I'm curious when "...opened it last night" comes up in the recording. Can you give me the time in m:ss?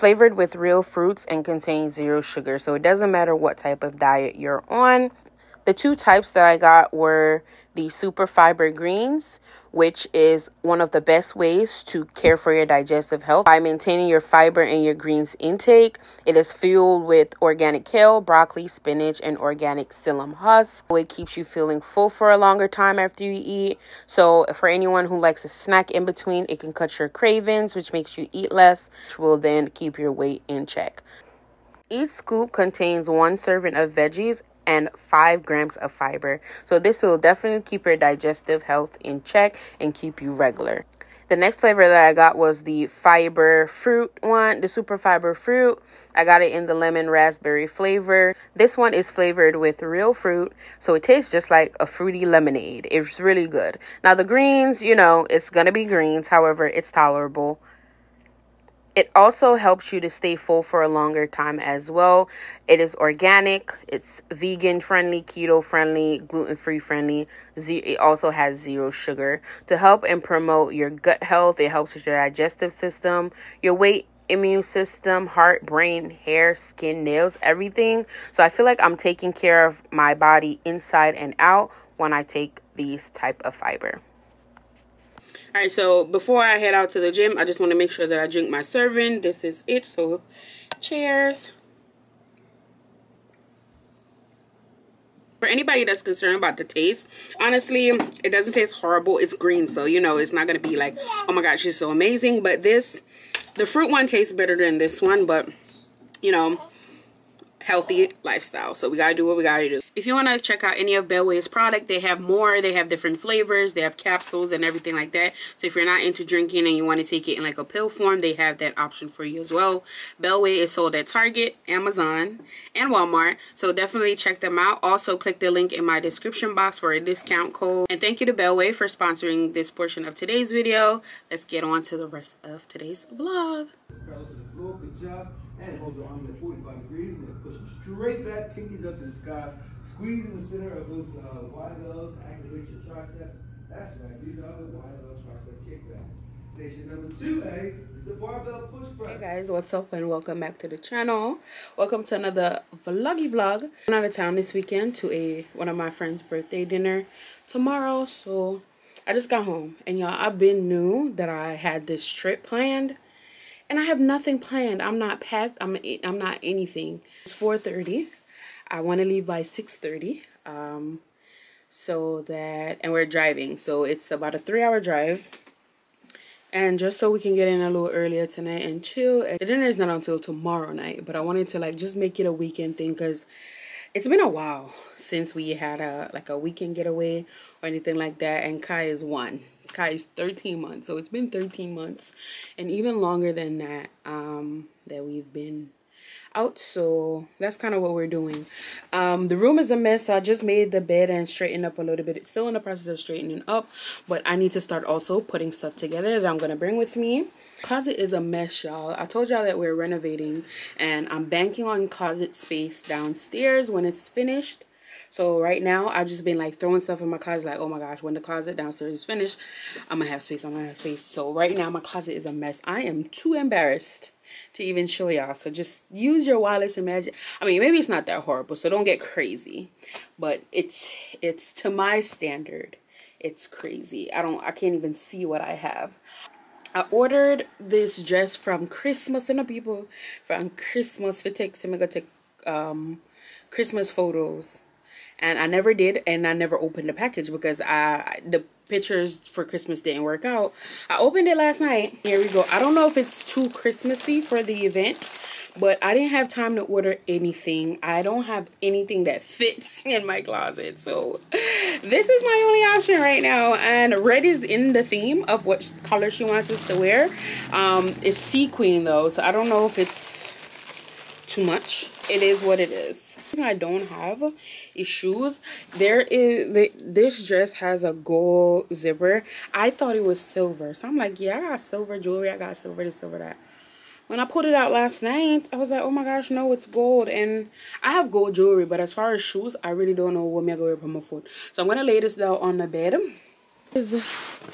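4:10.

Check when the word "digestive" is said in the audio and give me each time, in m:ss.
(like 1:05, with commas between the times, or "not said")
0:12, 0:37, 1:12.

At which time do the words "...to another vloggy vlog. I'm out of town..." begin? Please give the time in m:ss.
2:32.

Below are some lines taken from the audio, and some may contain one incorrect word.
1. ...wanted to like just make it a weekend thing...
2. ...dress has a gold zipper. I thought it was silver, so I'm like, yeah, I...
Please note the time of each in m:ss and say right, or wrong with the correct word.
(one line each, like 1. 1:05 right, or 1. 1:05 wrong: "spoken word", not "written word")
1. 3:01 right
2. 4:37 right.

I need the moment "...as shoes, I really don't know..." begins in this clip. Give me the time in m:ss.
4:49.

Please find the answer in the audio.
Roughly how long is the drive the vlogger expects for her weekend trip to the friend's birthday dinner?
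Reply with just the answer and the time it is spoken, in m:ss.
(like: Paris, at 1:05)
3 hours, at 2:54.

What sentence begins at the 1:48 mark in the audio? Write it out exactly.
So we gotta do what we gotta do.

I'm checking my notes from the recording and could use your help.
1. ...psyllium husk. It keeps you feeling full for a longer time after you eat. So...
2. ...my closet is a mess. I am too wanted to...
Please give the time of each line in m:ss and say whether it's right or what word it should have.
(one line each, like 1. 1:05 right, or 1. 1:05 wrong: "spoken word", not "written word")
1. 0:19 right
2. 3:41 wrong: "embarrassed", not "wanted".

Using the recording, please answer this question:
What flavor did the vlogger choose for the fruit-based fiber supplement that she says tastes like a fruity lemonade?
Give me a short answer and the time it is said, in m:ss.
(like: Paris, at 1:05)
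lemon raspberry, at 0:46.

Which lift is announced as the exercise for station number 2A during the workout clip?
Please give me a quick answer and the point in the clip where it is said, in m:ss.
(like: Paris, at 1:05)
barbell push press, at 2:28.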